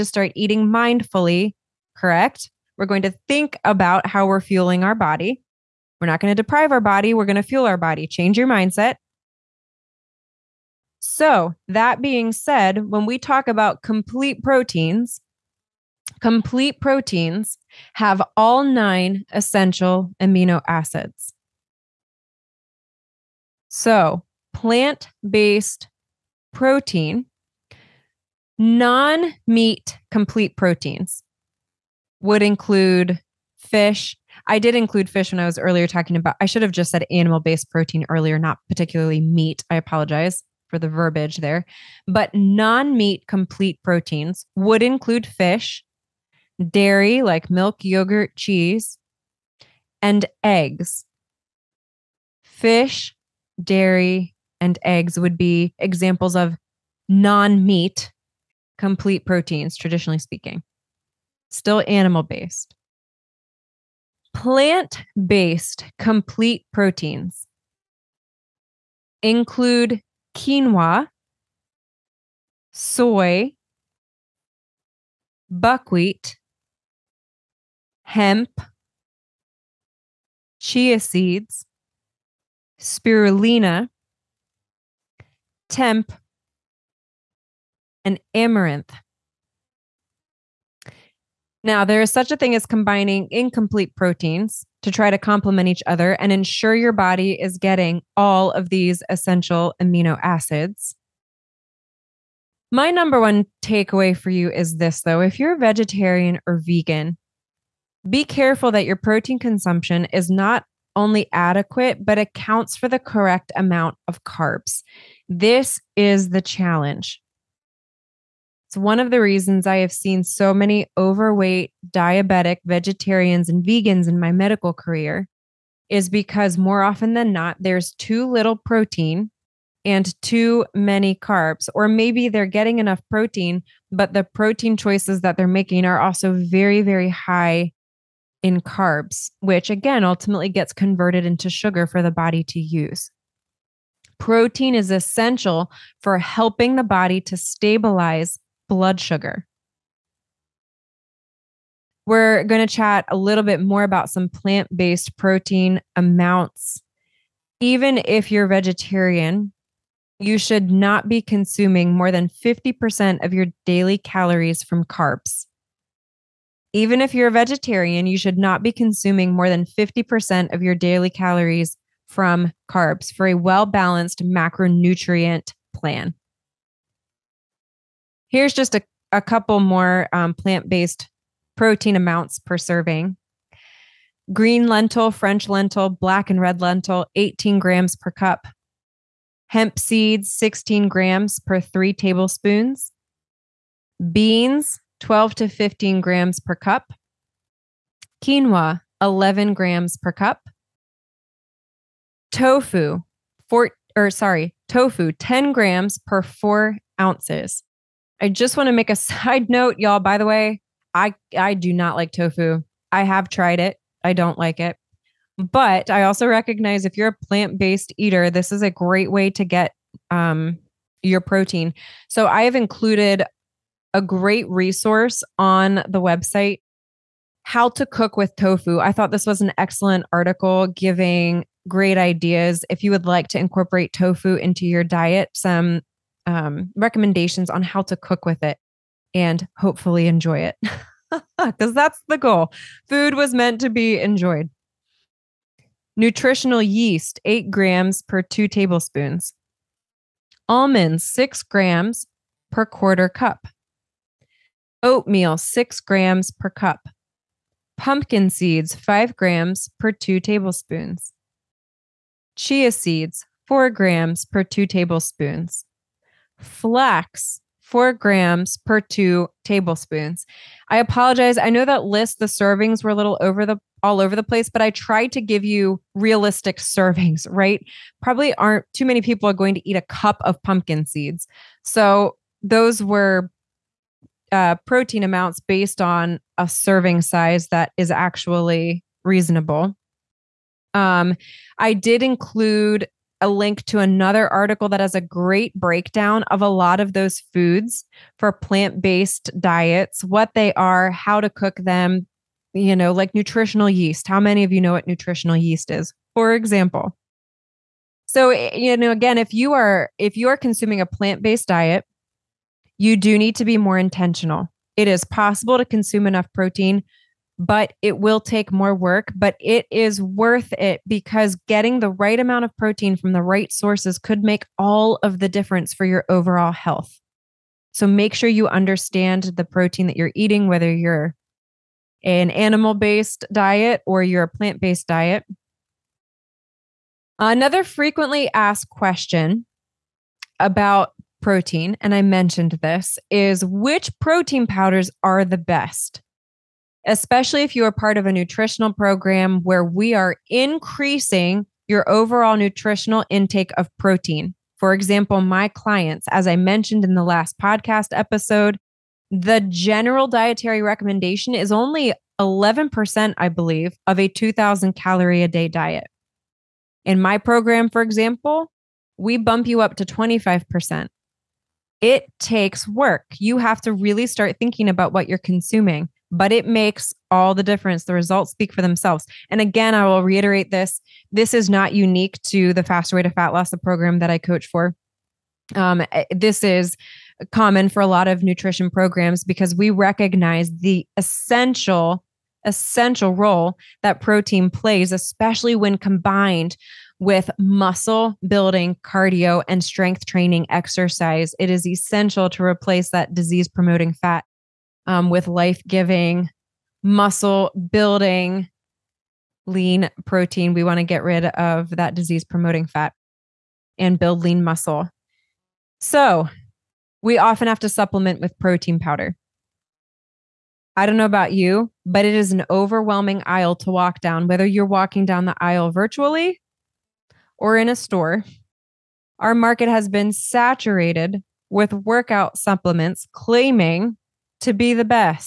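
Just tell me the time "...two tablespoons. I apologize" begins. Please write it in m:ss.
4:28.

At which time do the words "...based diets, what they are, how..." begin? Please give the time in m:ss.
4:58.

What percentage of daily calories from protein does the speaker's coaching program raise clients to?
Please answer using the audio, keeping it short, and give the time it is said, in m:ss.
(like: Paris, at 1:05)
25%, at 6:09.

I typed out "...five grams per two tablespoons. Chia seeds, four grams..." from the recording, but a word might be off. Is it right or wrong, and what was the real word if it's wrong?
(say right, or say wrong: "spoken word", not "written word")
right.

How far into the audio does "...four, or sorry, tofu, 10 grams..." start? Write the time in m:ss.
3:23.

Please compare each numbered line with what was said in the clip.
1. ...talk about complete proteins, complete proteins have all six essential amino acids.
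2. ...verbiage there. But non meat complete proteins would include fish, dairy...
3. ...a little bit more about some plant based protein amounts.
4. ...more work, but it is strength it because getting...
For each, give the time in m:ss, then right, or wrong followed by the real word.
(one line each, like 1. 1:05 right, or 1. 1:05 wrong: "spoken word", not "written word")
1. 0:13 wrong: "nine", not "six"
2. 0:40 right
3. 2:33 right
4. 5:18 wrong: "worth", not "strength".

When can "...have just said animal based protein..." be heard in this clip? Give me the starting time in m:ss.
0:36.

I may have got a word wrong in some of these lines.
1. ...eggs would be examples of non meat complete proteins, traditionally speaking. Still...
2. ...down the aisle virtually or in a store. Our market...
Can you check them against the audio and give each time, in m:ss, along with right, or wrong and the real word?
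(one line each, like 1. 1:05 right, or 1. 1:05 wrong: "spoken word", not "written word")
1. 0:54 right
2. 7:05 right.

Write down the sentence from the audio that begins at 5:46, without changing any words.
especially if you are part of a nutritional program where we are increasing your overall nutritional intake of protein.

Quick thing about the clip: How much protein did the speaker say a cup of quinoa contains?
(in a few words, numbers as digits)
11 grams.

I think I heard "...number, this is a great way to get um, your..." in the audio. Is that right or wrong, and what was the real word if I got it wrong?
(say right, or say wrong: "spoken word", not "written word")
wrong: "eater", not "number".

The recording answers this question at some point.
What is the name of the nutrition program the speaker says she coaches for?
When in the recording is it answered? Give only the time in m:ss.
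6:22.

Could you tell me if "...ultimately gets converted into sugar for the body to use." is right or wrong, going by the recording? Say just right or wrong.
right.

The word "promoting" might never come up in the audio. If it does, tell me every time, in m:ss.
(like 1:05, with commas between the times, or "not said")
6:43, 6:52.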